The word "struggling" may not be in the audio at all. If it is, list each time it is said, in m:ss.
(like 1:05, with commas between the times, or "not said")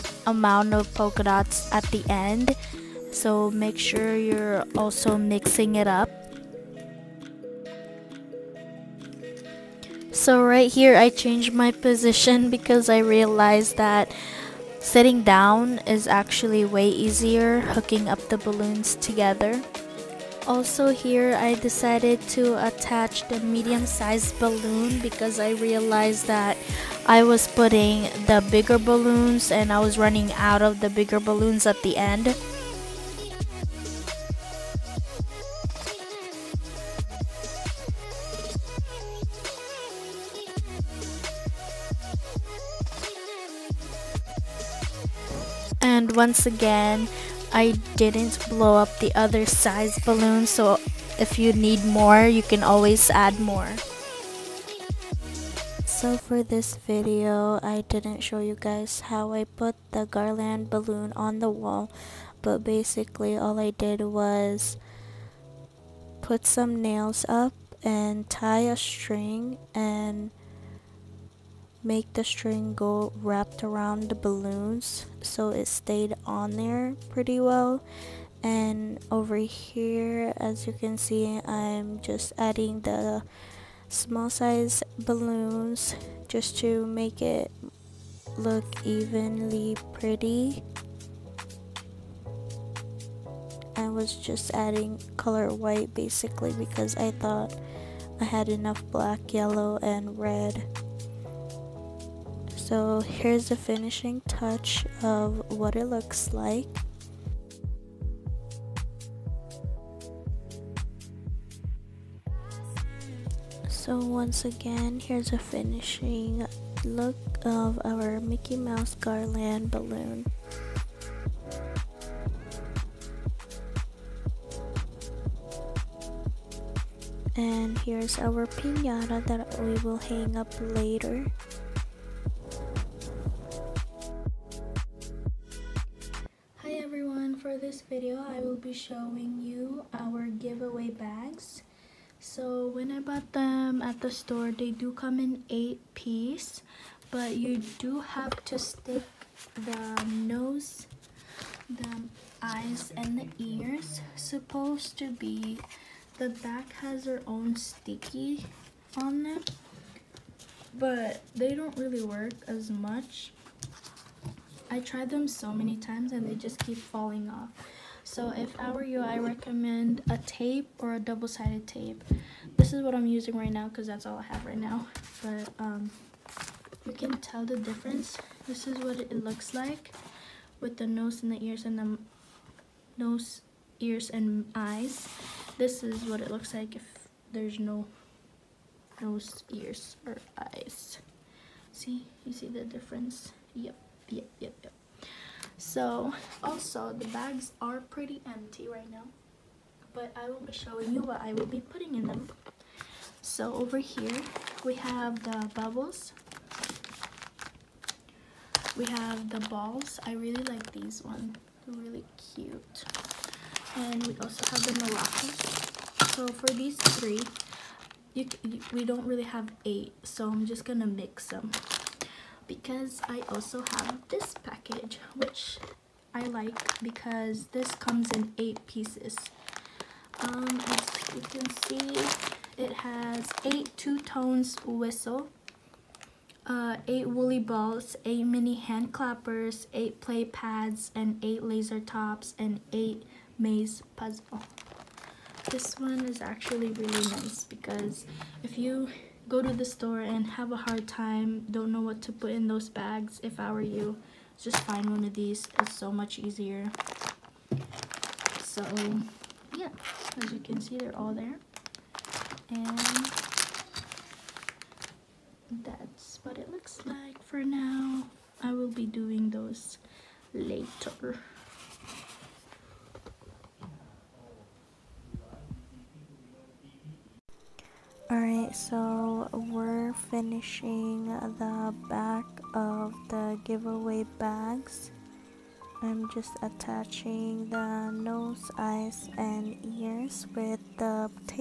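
not said.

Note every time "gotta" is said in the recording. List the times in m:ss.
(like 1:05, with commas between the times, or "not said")
not said.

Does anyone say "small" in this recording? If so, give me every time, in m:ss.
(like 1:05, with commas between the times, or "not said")
1:23.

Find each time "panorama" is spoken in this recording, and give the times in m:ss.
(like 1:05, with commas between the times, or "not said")
not said.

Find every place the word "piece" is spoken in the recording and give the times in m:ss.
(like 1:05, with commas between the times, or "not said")
2:25, 3:48.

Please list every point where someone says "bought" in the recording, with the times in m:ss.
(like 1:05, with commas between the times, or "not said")
2:22.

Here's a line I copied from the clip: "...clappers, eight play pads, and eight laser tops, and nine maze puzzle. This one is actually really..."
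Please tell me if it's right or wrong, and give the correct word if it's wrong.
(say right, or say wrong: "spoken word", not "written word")
wrong: "eight", not "nine".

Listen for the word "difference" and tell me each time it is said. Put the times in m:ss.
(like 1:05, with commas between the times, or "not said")
2:57, 3:12.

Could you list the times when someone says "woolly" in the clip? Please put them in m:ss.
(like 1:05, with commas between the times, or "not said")
3:57.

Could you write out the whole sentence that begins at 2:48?
So if I were you, I recommend a tape or a double-sided tape.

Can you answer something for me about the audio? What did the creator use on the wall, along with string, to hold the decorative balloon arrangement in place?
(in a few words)
Nails.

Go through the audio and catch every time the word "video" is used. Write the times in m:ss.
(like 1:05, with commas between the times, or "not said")
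0:56, 2:18.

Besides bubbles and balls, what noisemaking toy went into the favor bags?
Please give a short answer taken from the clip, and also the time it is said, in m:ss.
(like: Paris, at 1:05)
Maracas, at 3:34.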